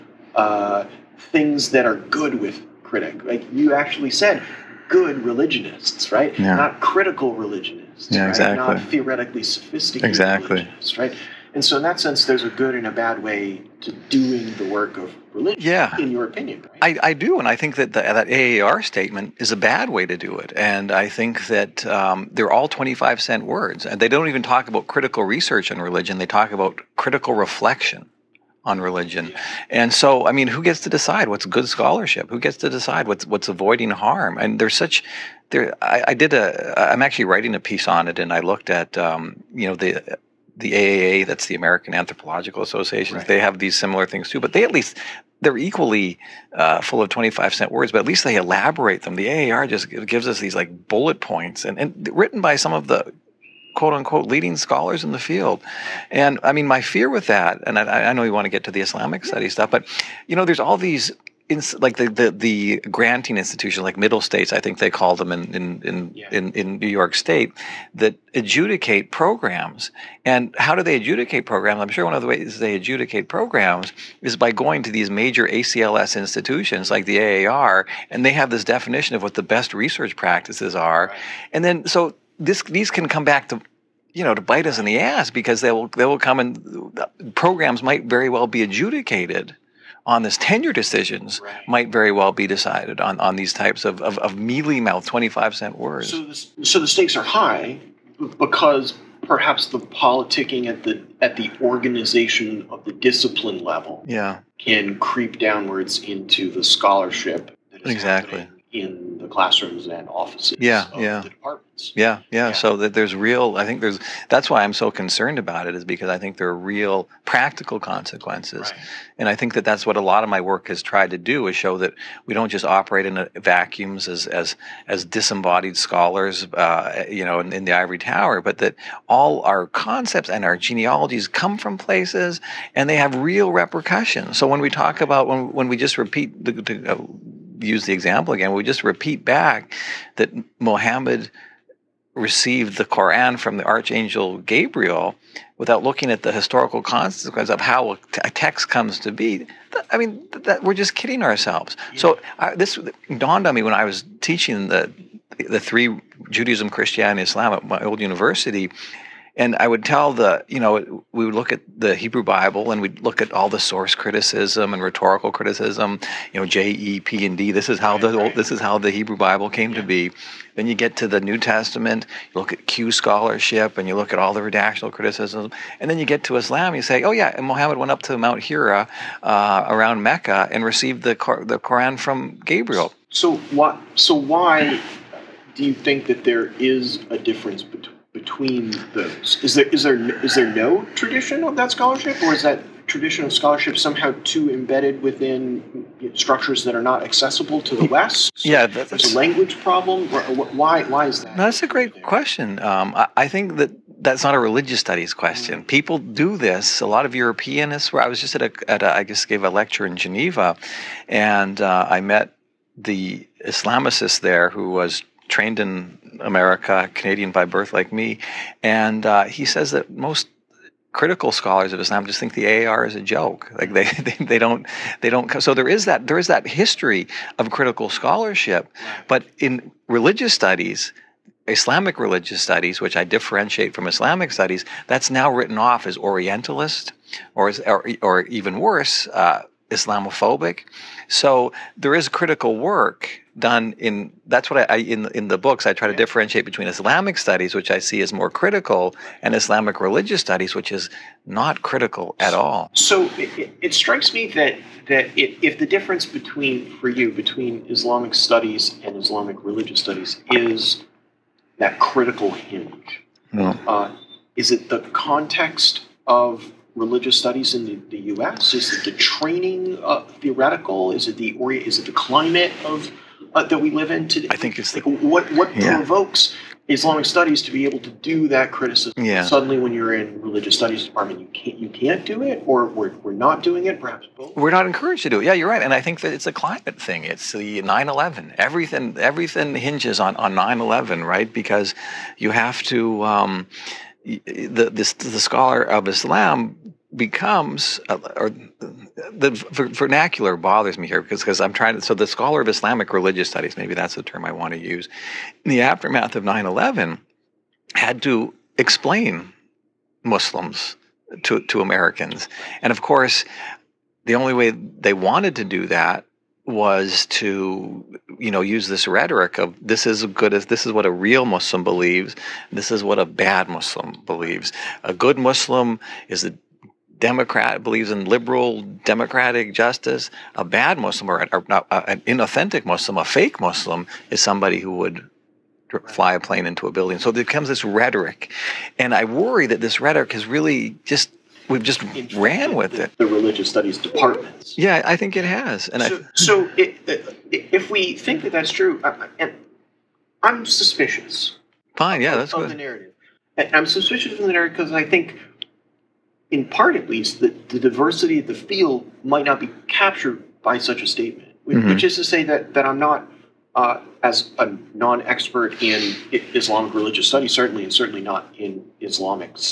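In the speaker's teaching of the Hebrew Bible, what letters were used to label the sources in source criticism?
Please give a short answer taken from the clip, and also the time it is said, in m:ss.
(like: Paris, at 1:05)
J, E, P, and D, at 2:46.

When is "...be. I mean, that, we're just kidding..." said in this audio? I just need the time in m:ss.
2:29.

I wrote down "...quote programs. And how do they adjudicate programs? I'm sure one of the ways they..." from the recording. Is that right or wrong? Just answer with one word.
wrong.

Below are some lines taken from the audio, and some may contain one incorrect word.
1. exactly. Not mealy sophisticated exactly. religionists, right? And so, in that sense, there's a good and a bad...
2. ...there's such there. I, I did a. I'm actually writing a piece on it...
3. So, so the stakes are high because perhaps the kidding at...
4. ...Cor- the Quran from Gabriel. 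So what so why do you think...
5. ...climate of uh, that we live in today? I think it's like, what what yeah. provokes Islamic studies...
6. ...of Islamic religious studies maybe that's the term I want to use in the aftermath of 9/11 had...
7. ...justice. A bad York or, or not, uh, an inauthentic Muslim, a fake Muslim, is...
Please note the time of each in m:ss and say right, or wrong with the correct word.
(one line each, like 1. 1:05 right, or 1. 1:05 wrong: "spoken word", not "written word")
1. 0:08 wrong: "theoretically", not "mealy"
2. 0:34 right
3. 1:36 wrong: "politicking", not "kidding"
4. 3:01 right
5. 4:31 right
6. 5:02 right
7. 5:29 wrong: "Muslim", not "York".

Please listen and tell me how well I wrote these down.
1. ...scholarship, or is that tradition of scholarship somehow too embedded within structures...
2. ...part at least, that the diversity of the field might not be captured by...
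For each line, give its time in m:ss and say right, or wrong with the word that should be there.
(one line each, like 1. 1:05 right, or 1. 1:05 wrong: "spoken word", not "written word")
1. 3:11 right
2. 5:56 right.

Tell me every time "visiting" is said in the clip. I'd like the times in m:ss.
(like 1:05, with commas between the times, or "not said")
not said.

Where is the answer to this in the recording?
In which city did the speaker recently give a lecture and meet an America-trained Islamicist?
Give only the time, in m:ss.
3:29.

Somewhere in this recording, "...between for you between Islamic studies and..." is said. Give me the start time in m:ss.
4:16.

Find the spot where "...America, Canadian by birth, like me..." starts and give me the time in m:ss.
3:36.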